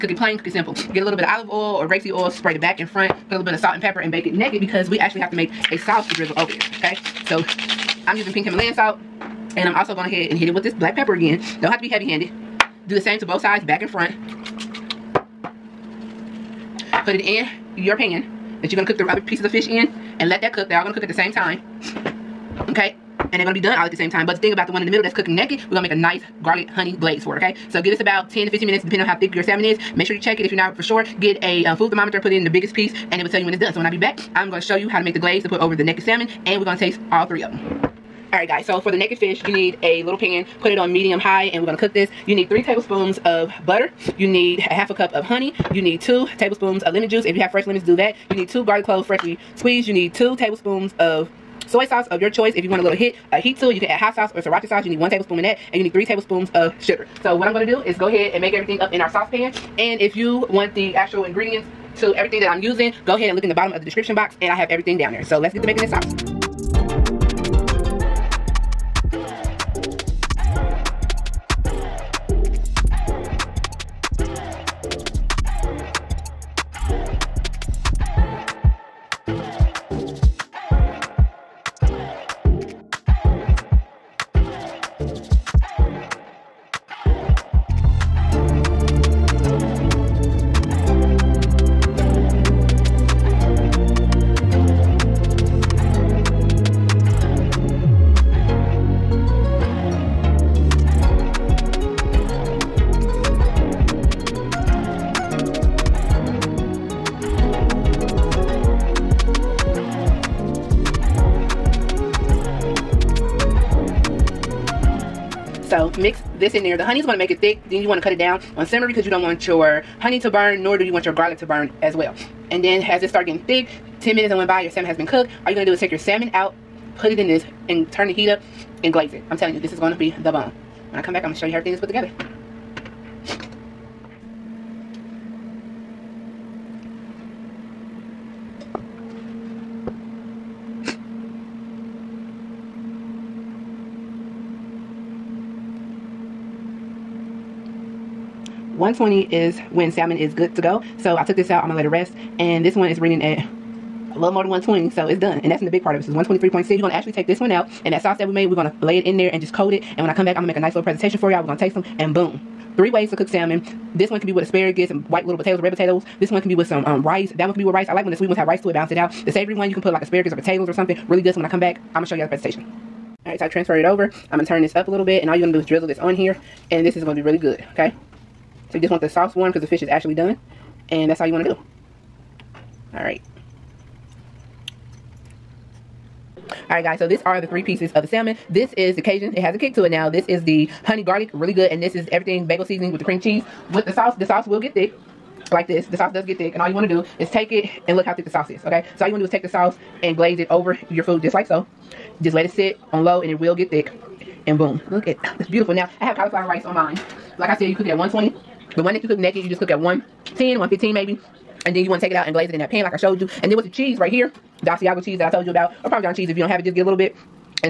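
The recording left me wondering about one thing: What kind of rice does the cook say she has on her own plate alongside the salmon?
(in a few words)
Cauliflower rice.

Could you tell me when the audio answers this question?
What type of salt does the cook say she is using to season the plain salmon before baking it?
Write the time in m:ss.
0:08.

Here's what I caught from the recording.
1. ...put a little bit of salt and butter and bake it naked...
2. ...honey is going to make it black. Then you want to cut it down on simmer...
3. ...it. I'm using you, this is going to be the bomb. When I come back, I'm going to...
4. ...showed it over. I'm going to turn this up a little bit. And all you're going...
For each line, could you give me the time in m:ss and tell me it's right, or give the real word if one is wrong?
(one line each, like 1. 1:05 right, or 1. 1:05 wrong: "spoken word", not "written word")
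1. 0:03 wrong: "pepper", not "butter"
2. 1:56 wrong: "thick", not "black"
3. 2:09 wrong: "telling", not "using"
4. 2:53 wrong: "transferred", not "showed".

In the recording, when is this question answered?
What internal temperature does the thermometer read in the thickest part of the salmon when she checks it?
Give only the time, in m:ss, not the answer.
2:36.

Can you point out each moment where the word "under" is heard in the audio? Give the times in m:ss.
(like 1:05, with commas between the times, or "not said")
not said.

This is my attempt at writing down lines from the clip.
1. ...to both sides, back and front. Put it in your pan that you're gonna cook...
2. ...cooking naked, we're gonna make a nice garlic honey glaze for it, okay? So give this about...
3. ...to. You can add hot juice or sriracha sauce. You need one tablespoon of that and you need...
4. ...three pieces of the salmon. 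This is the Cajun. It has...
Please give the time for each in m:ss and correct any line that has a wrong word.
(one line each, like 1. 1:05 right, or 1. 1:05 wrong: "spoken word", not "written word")
1. 0:13 right
2. 0:25 right
3. 0:53 wrong: "sauce", not "juice"
4. 3:07 right.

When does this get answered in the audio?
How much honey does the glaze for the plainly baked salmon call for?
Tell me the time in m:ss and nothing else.
0:44.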